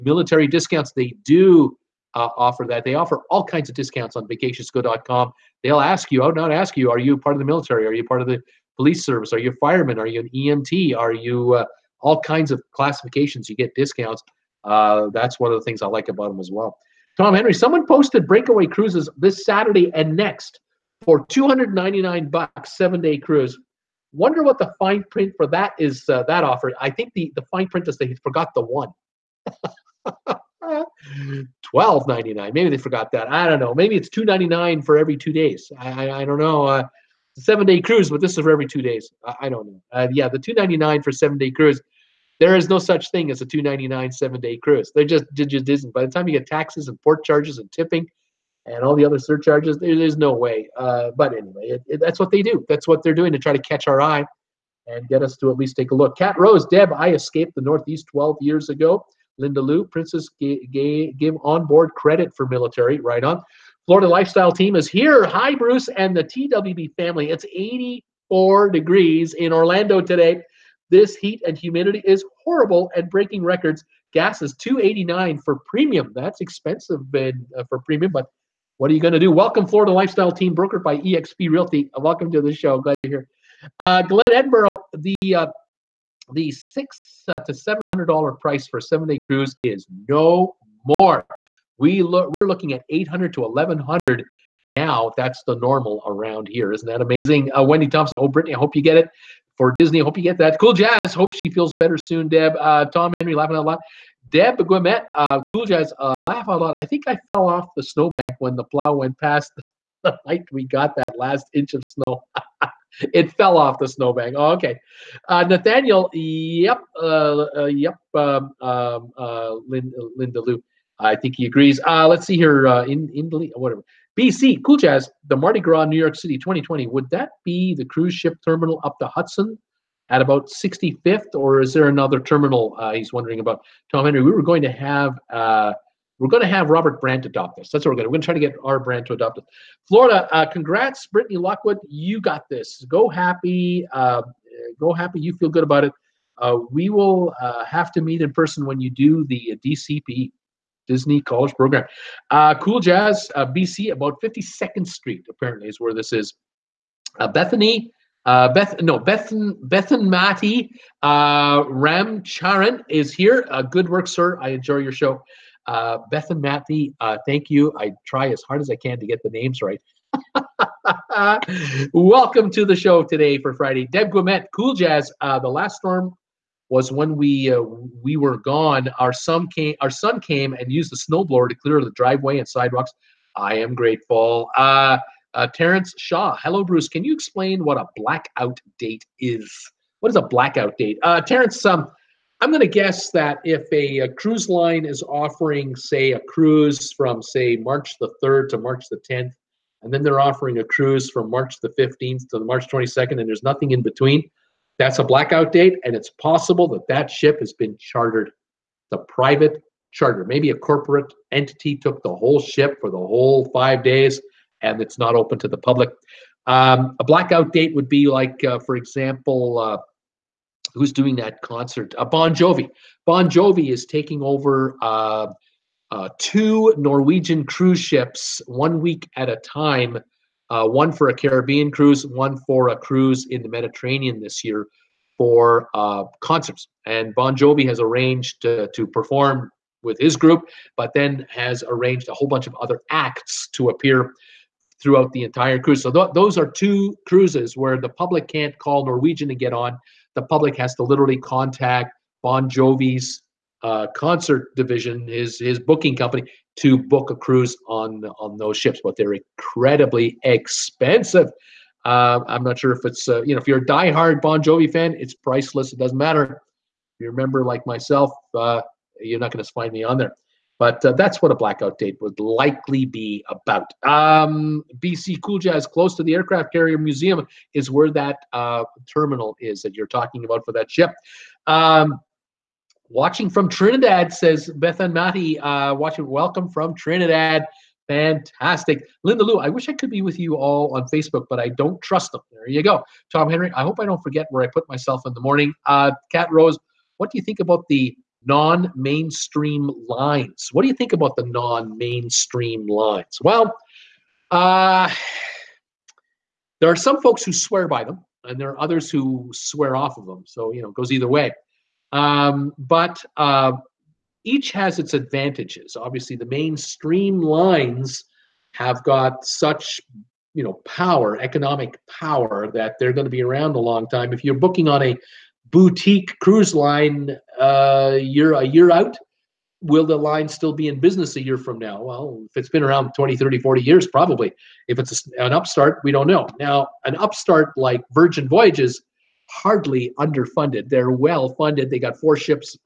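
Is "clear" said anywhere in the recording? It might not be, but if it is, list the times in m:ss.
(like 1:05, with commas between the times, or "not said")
3:01.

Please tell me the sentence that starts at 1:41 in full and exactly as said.
Hope she feels better soon, Deb.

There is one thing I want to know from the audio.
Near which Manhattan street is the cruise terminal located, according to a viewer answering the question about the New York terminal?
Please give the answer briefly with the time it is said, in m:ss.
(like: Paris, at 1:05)
52nd Street, at 2:34.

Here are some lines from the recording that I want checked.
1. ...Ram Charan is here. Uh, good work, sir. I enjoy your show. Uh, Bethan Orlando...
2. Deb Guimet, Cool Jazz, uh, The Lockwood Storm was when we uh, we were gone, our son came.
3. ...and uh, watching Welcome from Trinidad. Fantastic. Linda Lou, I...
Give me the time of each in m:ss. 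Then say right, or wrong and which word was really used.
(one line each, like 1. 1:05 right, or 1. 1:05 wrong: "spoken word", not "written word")
1. 2:41 wrong: "Matty", not "Orlando"
2. 2:53 wrong: "Last", not "Lockwood"
3. 4:44 right.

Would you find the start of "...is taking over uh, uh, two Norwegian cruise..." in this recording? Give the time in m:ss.
3:43.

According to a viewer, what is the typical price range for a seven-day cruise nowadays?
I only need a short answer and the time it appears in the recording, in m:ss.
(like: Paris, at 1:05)
$800 to $1,100, at 1:32.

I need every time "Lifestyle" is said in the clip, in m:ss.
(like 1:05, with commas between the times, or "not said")
1:04, 1:19.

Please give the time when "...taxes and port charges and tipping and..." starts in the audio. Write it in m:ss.
0:46.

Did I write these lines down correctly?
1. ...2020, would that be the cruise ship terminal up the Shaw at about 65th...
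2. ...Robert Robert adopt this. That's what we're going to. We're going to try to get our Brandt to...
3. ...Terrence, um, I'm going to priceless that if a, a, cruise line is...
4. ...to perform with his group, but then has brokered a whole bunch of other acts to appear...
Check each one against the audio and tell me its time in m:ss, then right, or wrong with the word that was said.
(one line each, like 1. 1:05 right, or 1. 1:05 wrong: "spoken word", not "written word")
1. 2:06 wrong: "Hudson", not "Shaw"
2. 2:16 wrong: "Brandt", not "Robert"
3. 3:11 wrong: "guess", not "priceless"
4. 3:58 wrong: "arranged", not "brokered".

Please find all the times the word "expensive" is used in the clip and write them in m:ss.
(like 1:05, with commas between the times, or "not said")
1:16, 4:20.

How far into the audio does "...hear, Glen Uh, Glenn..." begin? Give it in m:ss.
1:23.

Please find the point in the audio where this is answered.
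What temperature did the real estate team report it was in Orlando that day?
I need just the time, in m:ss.
1:07.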